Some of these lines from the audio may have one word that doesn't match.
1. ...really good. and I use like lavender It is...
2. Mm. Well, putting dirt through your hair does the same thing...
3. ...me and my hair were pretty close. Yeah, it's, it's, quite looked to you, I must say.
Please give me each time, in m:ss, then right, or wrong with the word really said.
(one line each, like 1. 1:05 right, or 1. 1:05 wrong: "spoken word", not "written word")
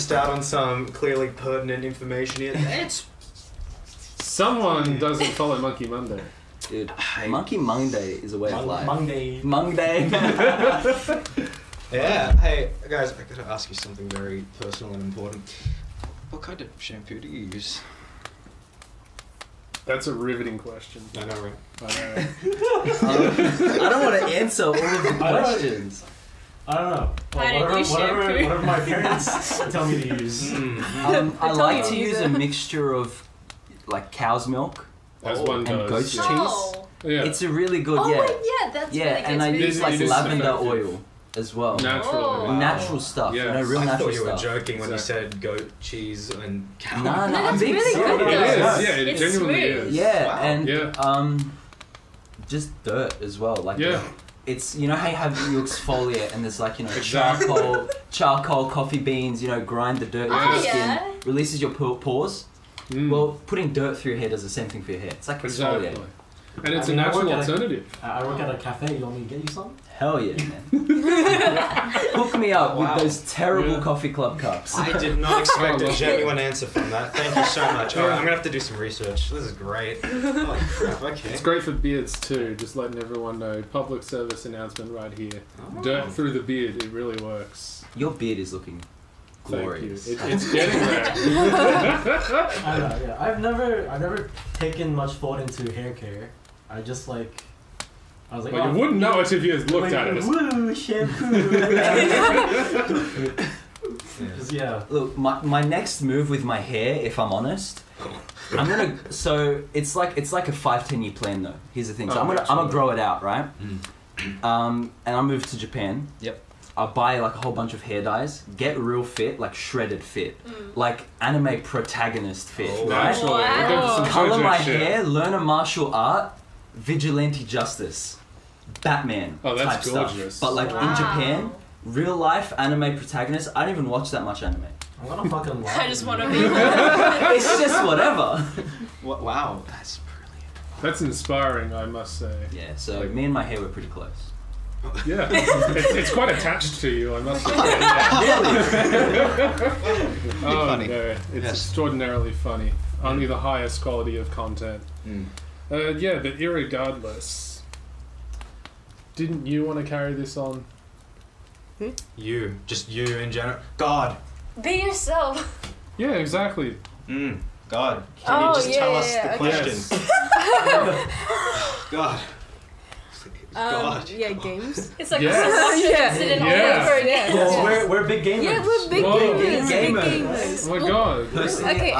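1. 0:39 right
2. 1:02 right
3. 2:23 wrong: "attached", not "looked".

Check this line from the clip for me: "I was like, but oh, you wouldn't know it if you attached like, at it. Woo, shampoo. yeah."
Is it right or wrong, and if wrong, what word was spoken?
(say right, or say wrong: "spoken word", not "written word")
wrong: "looked", not "attached".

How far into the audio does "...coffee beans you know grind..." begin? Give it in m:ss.
0:58.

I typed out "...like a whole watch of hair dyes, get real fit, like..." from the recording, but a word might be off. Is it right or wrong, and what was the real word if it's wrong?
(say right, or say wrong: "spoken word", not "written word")
wrong: "bunch", not "watch".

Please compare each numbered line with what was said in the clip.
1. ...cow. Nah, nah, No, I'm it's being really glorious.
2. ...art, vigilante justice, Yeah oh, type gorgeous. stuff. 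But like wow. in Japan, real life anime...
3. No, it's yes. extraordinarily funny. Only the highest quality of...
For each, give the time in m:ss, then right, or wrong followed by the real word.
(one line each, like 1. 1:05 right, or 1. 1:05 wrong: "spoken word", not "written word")
1. 0:46 wrong: "serious", not "glorious"
2. 2:05 wrong: "Batman", not "Yeah"
3. 2:30 right.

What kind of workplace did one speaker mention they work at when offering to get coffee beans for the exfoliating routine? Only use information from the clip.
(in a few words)
a cafe.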